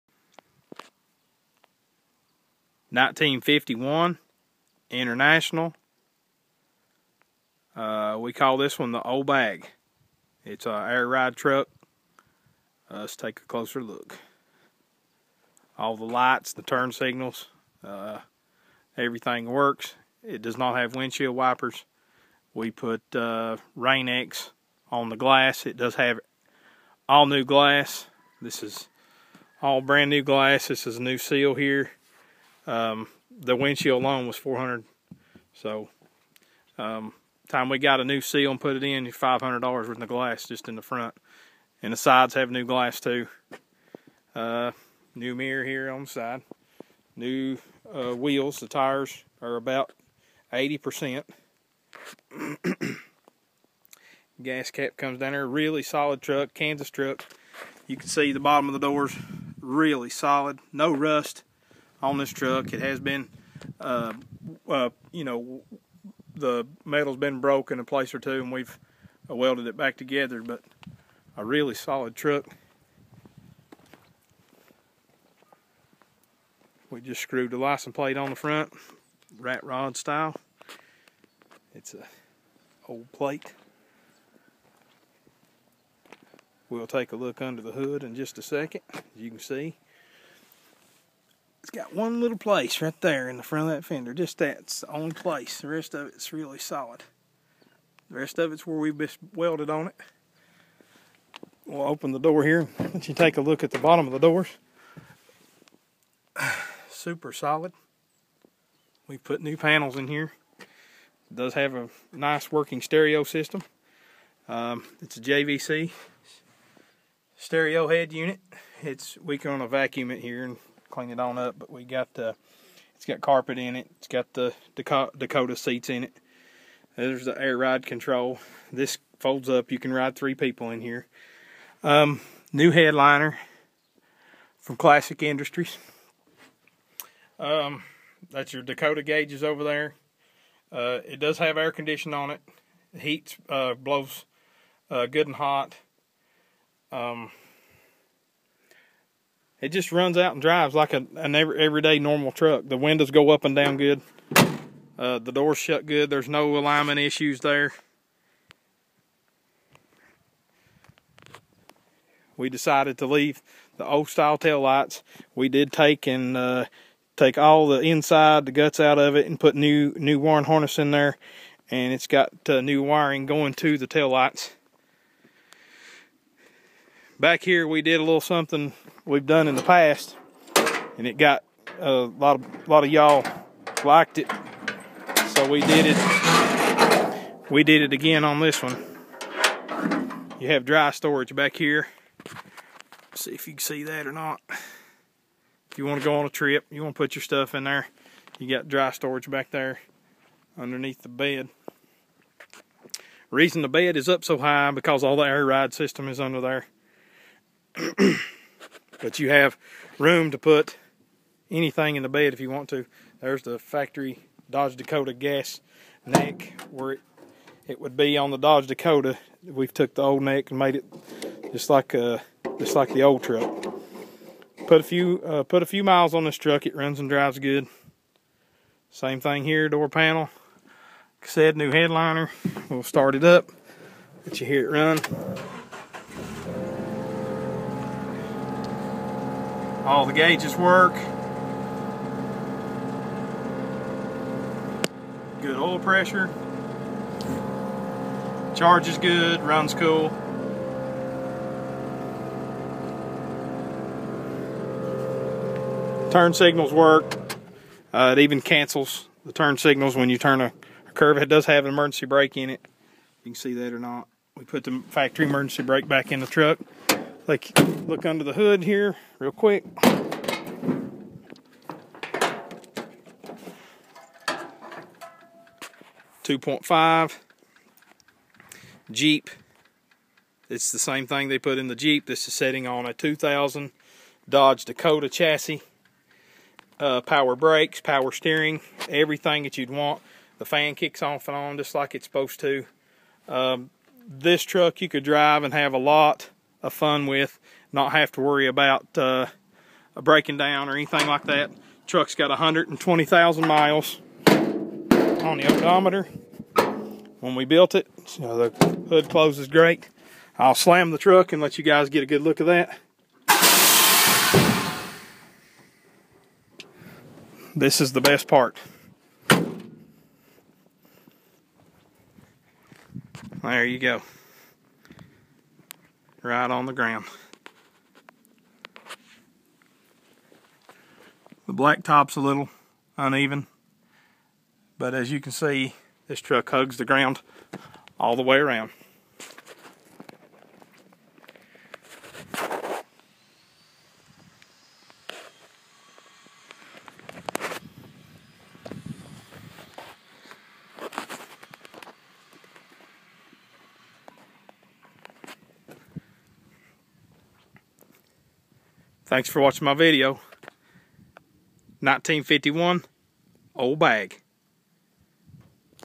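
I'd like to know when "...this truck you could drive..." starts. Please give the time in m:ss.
4:54.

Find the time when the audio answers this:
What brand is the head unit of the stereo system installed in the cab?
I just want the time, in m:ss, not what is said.
1:55.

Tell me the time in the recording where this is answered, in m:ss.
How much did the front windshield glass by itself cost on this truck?
0:34.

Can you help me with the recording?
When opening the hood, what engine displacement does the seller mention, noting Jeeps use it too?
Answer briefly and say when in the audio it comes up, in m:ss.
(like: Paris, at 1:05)
2.5, at 4:36.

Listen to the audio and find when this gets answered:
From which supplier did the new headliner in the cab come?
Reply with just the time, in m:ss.
2:14.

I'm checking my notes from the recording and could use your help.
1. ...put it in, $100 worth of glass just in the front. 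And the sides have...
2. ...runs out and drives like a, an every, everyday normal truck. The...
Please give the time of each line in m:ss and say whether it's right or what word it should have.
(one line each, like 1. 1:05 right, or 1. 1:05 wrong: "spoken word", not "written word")
1. 0:38 wrong: "500", not "100"
2. 2:29 right.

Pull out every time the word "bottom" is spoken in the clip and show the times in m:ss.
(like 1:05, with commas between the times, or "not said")
0:58, 1:43.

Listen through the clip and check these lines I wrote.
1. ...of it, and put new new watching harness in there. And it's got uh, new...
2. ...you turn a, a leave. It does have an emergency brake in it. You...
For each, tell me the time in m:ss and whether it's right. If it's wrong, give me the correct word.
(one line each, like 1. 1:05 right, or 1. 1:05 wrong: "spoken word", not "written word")
1. 2:48 wrong: "wiring", not "watching"
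2. 4:20 wrong: "curve", not "leave".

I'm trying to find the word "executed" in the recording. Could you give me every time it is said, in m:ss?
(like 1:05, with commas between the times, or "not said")
not said.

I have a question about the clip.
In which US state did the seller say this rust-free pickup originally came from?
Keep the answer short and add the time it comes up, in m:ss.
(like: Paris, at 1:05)
Kansas, at 0:56.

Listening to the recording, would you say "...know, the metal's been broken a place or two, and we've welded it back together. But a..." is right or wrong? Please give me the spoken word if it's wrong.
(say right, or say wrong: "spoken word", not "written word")
right.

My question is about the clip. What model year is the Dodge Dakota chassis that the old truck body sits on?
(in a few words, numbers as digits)
2000.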